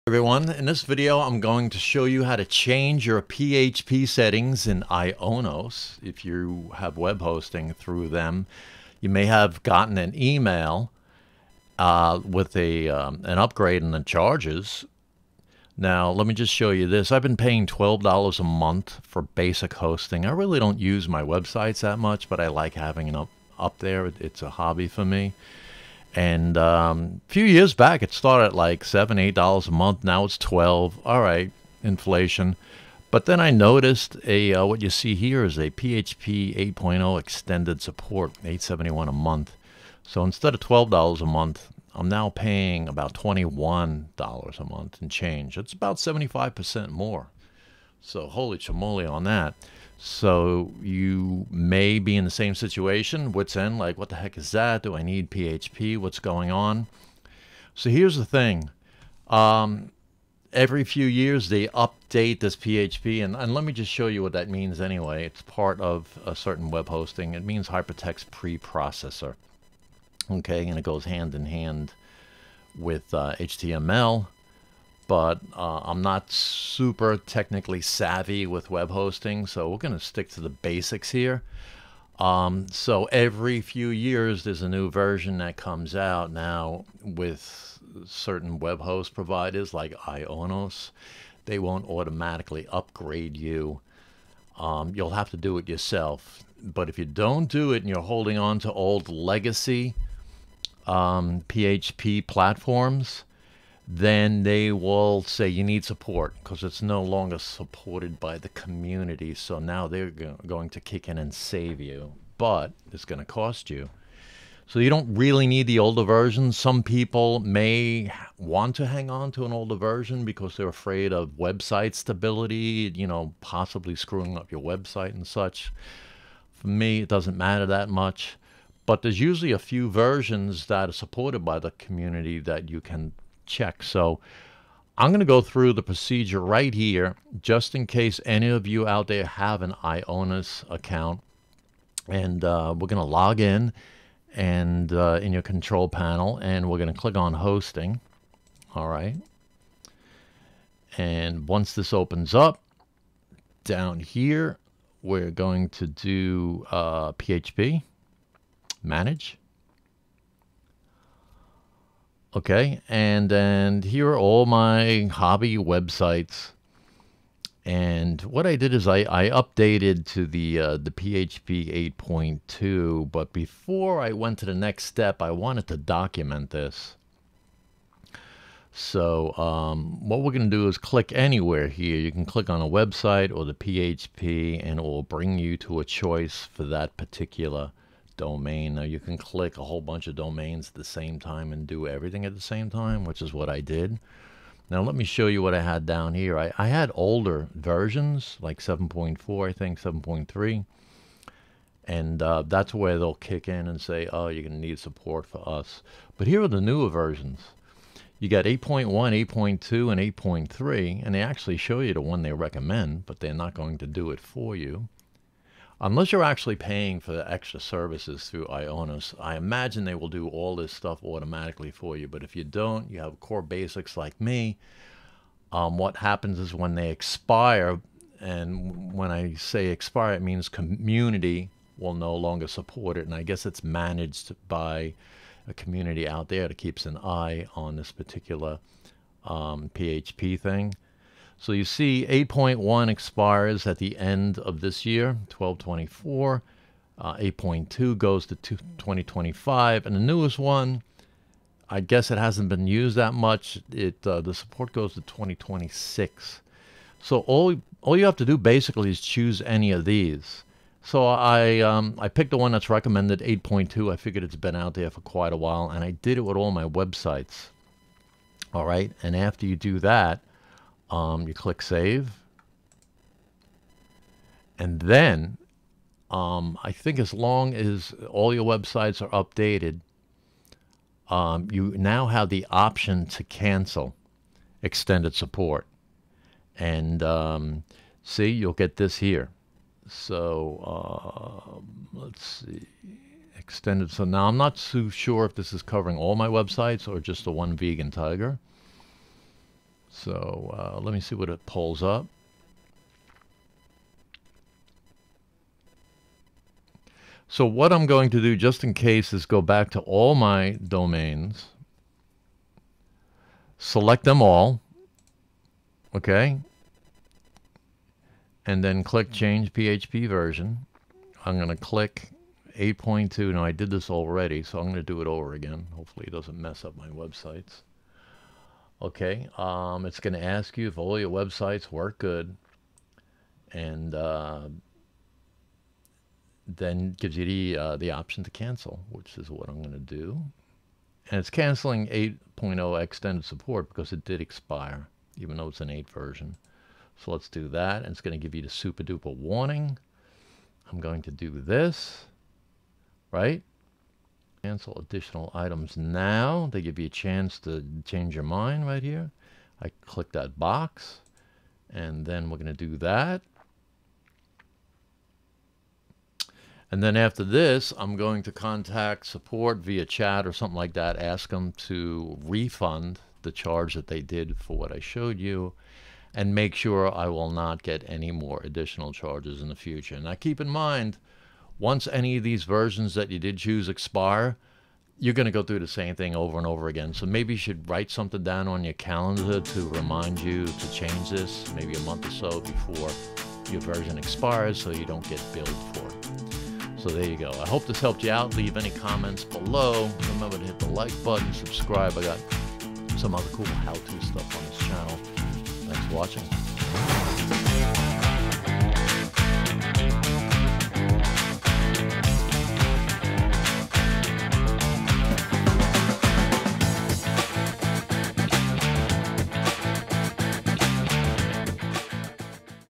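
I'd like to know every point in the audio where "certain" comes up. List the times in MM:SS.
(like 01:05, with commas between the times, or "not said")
01:06, 01:28.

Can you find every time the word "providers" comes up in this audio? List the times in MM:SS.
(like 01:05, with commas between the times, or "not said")
01:29.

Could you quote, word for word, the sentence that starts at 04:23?
I figured it's been out there for quite a while, and I did it with all my websites.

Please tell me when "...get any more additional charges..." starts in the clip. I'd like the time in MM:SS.
06:17.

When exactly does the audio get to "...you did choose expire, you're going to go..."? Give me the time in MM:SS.
06:23.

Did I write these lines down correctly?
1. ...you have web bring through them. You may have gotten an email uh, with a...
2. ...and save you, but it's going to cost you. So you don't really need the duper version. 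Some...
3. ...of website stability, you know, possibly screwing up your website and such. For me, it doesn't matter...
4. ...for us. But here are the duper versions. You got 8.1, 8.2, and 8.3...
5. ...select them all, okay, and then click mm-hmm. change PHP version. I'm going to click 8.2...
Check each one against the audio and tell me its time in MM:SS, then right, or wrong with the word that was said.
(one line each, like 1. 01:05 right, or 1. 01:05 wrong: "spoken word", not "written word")
1. 00:06 wrong: "hosting", not "bring"
2. 01:51 wrong: "older", not "duper"
3. 02:01 right
4. 03:25 wrong: "newer", not "duper"
5. 05:13 right.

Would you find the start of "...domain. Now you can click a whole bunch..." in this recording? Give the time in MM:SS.
03:08.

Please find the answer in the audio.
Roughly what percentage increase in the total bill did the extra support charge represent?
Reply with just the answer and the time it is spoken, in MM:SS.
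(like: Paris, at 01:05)
75 percent, at 00:45.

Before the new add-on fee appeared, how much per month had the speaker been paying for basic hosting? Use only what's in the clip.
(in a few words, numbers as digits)
$12.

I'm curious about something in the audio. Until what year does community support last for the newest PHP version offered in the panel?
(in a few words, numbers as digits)
2026.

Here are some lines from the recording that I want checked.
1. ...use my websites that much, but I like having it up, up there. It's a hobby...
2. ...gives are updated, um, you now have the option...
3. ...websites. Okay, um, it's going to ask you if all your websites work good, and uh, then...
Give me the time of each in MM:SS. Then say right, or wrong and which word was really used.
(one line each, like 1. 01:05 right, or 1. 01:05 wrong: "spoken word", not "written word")
1. 00:20 right
2. 04:38 wrong: "websites", not "gives"
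3. 05:26 right.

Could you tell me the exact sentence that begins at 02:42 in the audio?
Okay, and and here are all my hobby websites.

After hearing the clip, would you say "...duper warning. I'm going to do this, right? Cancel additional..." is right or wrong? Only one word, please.
right.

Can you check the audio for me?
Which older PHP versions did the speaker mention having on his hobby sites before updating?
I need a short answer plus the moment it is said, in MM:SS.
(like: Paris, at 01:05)
7.4 and 7.3, at 03:18.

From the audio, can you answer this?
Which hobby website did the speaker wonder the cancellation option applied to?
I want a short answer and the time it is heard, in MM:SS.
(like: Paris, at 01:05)
Vegan Tiger, at 04:57.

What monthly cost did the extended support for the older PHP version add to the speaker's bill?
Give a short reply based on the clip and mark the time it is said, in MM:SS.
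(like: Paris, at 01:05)
8.71, at 00:38.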